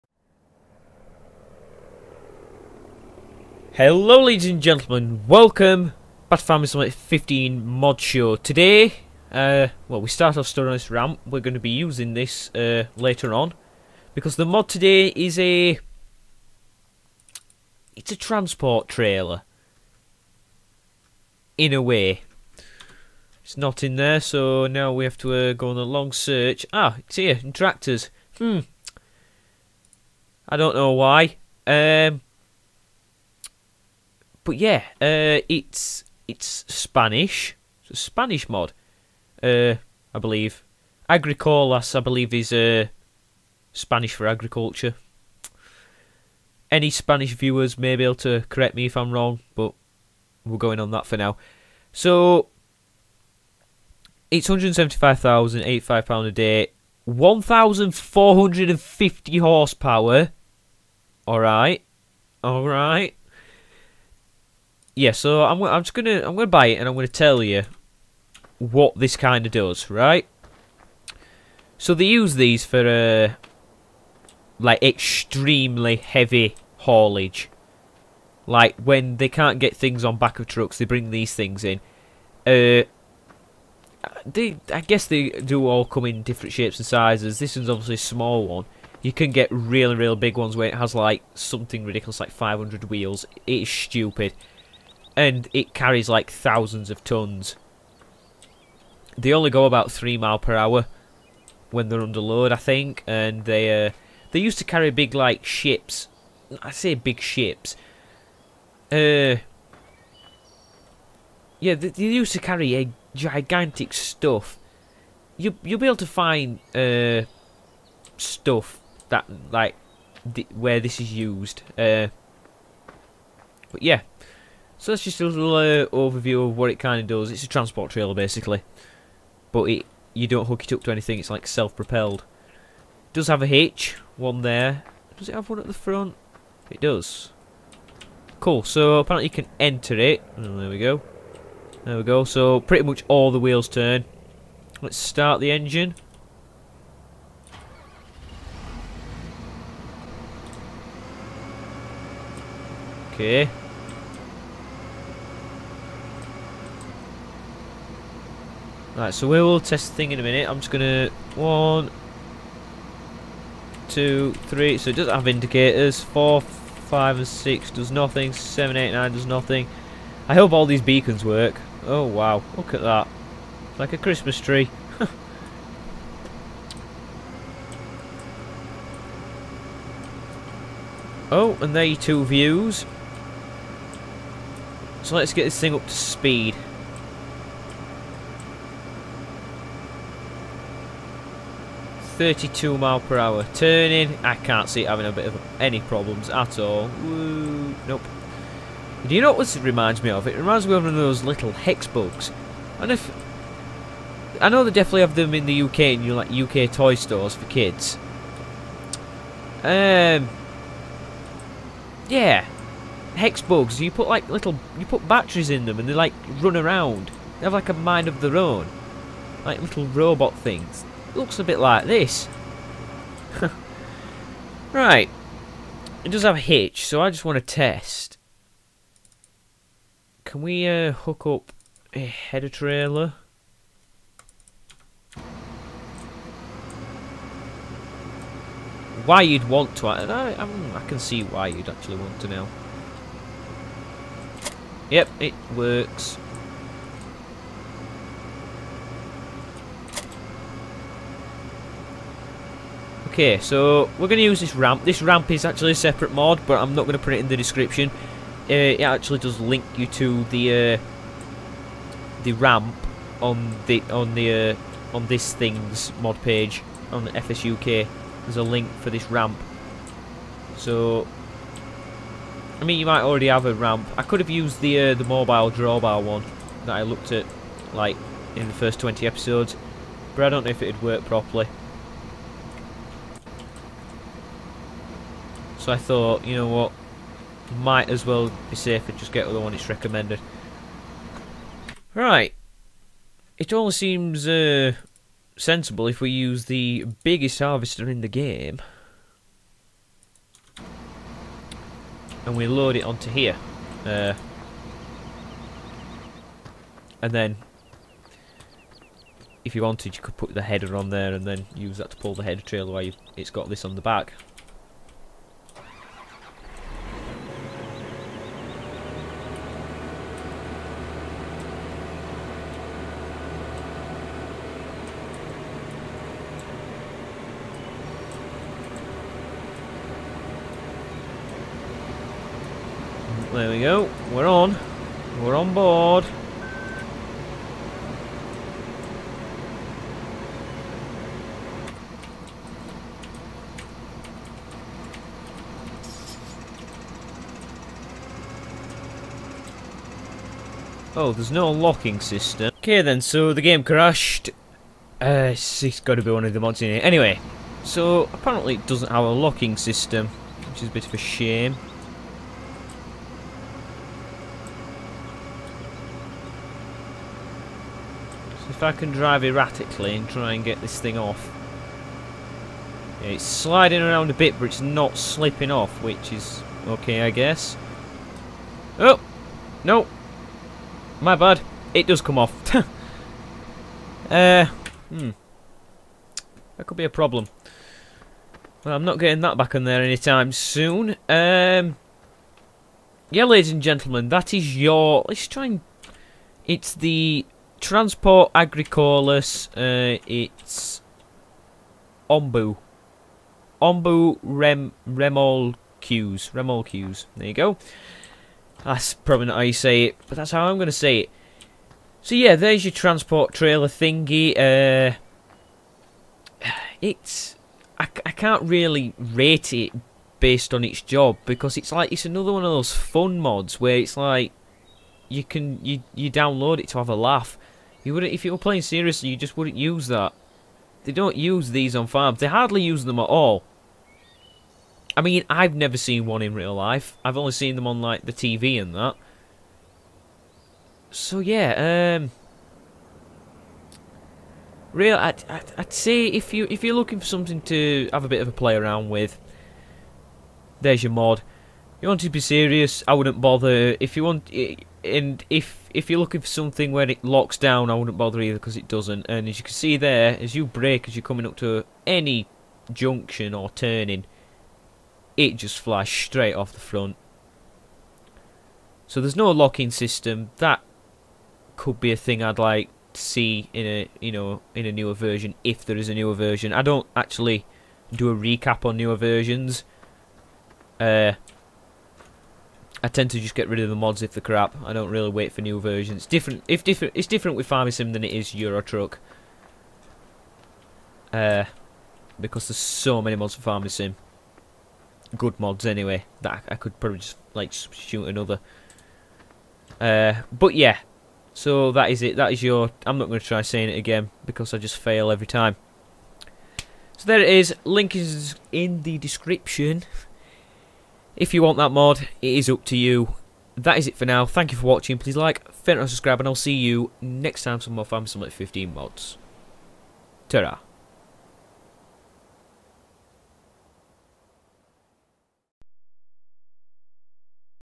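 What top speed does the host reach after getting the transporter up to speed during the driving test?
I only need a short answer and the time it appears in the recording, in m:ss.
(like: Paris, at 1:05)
32 mph, at 3:12.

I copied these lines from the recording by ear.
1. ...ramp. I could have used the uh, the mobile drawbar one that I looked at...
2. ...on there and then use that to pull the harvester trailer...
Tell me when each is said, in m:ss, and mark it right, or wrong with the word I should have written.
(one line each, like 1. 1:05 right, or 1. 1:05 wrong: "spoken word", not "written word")
1. 4:33 right
2. 5:10 wrong: "header", not "harvester".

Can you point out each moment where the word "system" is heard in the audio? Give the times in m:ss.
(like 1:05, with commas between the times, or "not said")
5:52, 5:59, 7:49.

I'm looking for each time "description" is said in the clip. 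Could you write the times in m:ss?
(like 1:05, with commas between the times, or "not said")
4:17, 8:28.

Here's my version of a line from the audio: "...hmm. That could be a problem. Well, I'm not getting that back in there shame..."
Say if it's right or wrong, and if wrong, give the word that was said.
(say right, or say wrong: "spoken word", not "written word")
wrong: "anytime", not "shame".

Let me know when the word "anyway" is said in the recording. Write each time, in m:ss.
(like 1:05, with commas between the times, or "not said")
5:56, 8:15.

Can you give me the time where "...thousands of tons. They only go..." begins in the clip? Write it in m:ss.
1:36.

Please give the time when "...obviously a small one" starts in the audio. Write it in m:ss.
1:27.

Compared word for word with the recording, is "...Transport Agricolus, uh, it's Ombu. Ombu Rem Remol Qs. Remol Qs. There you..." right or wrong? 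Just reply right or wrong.
right.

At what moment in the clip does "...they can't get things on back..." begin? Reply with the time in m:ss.
1:19.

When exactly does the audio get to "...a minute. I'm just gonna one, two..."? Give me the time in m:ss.
2:40.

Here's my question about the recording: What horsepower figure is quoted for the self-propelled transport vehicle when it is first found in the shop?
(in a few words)
1,450 horsepower.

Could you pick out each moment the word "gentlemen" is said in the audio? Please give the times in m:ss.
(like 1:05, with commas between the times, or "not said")
0:04, 6:33.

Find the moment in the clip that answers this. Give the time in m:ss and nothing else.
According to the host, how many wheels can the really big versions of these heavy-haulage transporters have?
1:32.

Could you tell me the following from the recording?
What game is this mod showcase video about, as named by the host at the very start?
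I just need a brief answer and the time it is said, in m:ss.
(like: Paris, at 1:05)
Farming Simulator 15, at 0:06.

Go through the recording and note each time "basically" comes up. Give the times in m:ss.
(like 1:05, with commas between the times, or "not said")
2:08.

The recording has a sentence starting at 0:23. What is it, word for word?
It's not in there so now we have to uh, go on a long search.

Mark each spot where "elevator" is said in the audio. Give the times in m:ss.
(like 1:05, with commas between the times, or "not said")
not said.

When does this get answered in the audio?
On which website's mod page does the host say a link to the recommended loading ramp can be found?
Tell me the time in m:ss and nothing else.
4:27.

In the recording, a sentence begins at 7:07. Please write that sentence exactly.
You would if you were playing seriously, you just wouldn't use that.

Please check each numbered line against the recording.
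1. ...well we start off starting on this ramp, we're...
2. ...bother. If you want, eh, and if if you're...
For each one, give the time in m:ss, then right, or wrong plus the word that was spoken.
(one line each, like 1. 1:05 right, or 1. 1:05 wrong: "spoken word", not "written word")
1. 0:09 right
2. 7:33 right.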